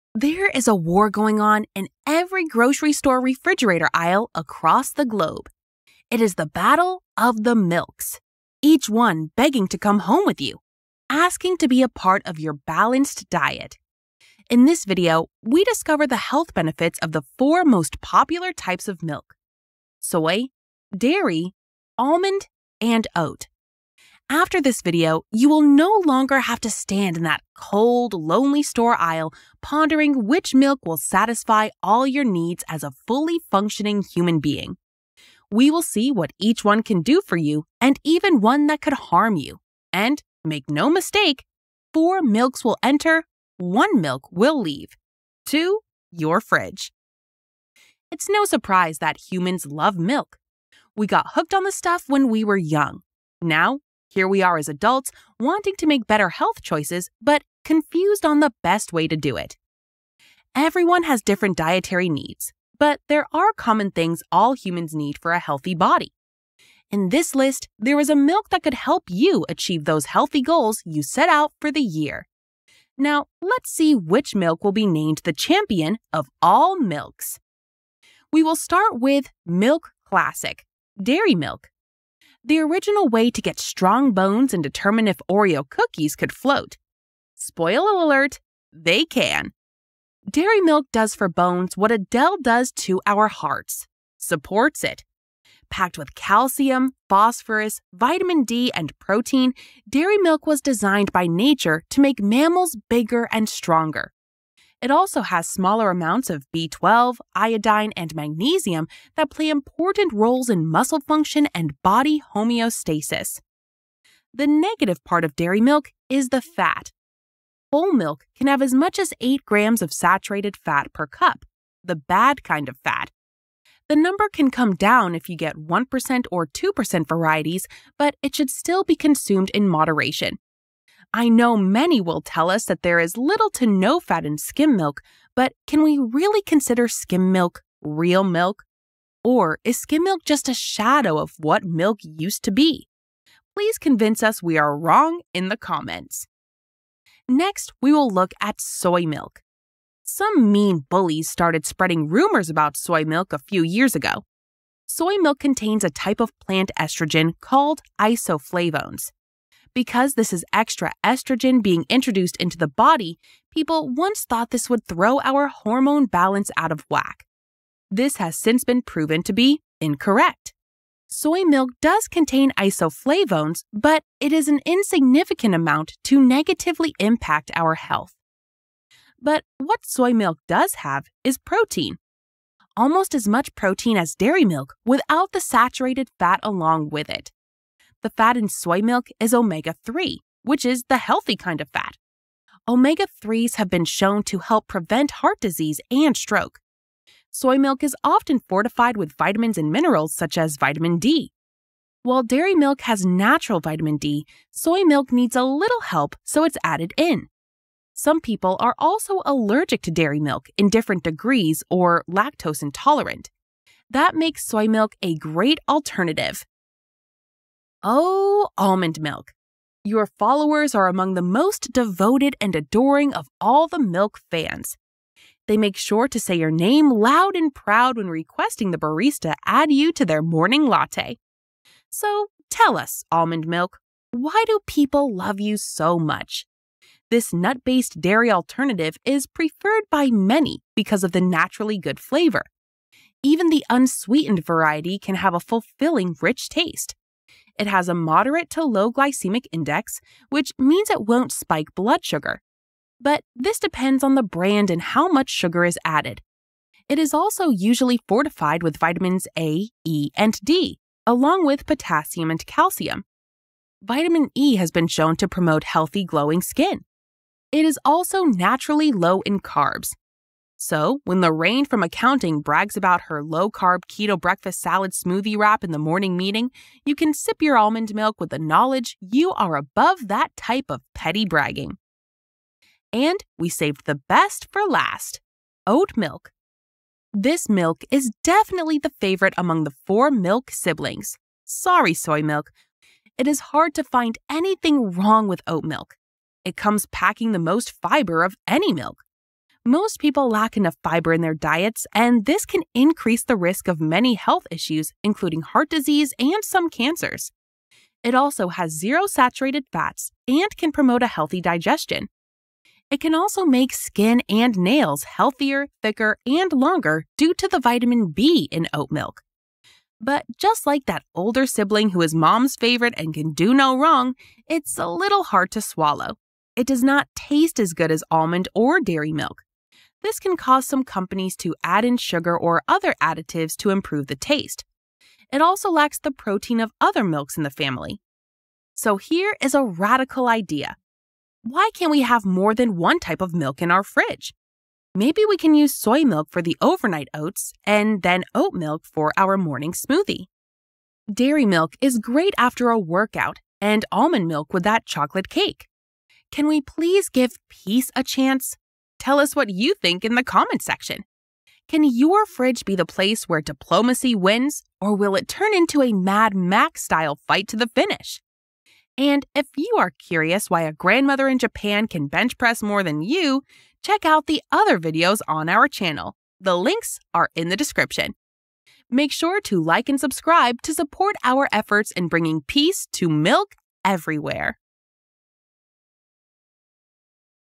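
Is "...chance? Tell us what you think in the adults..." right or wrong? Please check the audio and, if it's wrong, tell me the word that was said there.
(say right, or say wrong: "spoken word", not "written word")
wrong: "comments", not "adults".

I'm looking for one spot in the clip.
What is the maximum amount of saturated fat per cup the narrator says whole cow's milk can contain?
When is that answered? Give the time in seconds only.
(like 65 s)
119 s.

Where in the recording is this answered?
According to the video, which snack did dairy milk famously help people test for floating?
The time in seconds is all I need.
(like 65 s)
85 s.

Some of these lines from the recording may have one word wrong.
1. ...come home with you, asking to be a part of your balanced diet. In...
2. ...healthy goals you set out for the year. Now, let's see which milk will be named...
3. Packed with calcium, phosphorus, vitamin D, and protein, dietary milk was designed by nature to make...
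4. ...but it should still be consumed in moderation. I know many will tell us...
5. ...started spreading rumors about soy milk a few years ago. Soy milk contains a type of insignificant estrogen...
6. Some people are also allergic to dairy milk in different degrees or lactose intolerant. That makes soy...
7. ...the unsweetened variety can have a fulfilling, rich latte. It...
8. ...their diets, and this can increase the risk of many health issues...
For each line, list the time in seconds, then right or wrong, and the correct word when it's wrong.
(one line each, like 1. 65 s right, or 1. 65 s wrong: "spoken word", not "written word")
1. 9 s right
2. 70 s right
3. 95 s wrong: "dairy", not "dietary"
4. 127 s right
5. 151 s wrong: "plant", not "insignificant"
6. 207 s right
7. 243 s wrong: "taste", not "latte"
8. 301 s right.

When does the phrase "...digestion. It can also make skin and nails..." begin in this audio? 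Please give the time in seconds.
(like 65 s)
311 s.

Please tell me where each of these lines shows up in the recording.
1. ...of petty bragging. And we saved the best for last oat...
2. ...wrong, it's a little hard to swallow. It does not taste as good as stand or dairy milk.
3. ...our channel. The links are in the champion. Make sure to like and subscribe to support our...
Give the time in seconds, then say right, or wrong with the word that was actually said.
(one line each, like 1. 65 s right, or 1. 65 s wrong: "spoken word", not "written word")
1. 280 s right
2. 323 s wrong: "almond", not "stand"
3. 375 s wrong: "description", not "champion".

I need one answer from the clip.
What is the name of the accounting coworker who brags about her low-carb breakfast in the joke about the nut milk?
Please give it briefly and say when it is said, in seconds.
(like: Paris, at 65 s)
Lorraine, at 271 s.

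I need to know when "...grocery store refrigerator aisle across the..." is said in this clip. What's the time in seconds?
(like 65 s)
2 s.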